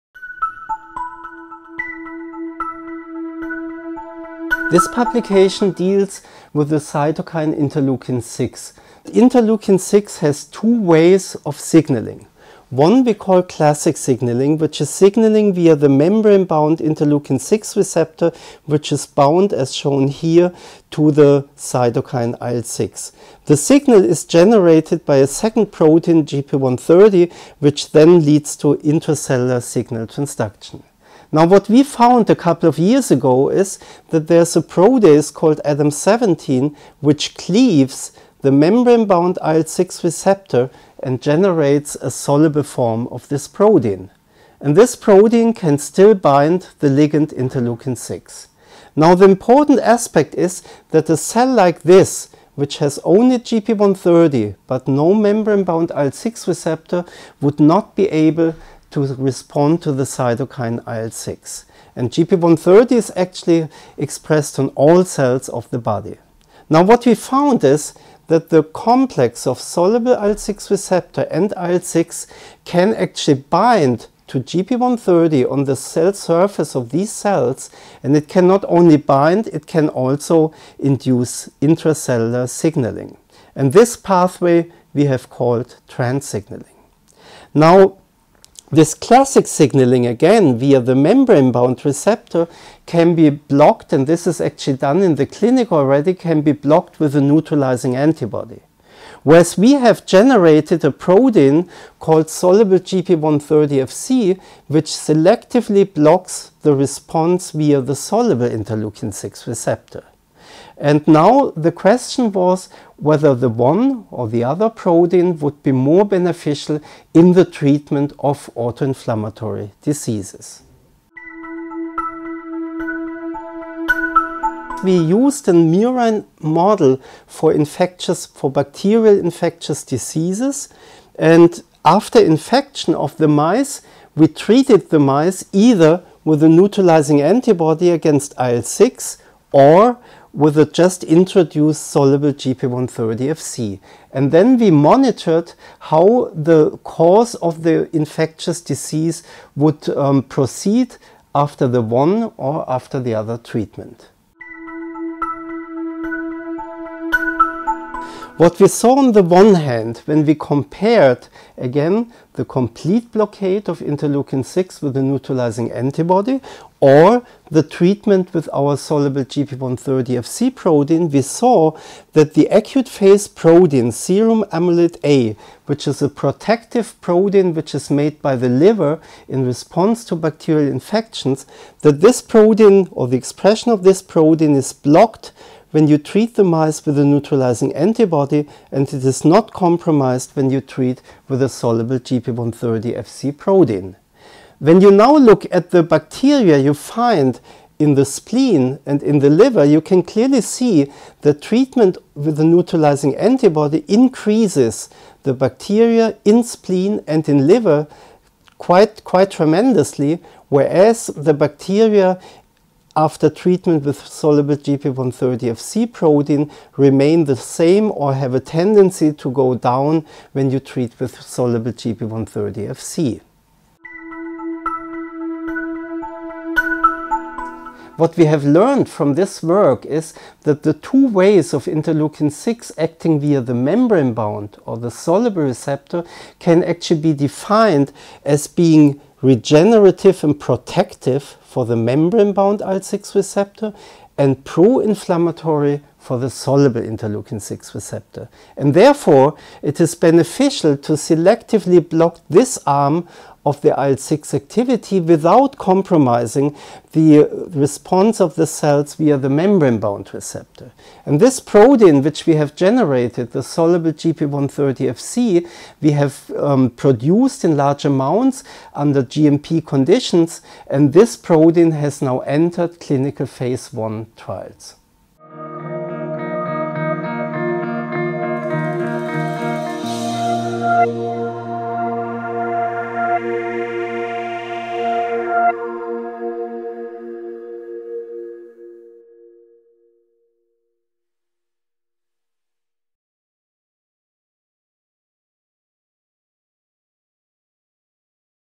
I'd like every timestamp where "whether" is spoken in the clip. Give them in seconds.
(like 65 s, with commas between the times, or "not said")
112 s.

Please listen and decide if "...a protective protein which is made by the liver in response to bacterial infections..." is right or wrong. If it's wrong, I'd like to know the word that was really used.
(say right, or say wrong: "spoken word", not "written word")
right.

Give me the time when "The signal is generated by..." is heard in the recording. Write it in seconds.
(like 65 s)
23 s.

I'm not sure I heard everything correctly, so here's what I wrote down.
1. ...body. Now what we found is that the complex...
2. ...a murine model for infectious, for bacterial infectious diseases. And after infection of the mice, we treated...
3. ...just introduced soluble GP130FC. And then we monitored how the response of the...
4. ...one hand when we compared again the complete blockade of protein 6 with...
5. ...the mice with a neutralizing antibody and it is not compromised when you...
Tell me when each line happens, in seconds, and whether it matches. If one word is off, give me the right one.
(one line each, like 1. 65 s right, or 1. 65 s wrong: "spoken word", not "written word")
1. 65 s right
2. 125 s right
3. 140 s wrong: "course", not "response"
4. 159 s wrong: "interleukin", not "protein"
5. 186 s right.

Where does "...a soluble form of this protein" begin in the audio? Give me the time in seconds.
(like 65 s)
41 s.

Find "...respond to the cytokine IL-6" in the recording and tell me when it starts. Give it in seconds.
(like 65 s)
59 s.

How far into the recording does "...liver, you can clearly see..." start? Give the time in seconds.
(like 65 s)
199 s.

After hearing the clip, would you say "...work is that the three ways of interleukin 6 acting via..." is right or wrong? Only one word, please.
wrong.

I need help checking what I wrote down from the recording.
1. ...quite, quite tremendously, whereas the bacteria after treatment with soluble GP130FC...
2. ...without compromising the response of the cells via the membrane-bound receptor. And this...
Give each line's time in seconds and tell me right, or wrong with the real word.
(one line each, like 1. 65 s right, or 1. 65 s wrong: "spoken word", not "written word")
1. 208 s right
2. 254 s right.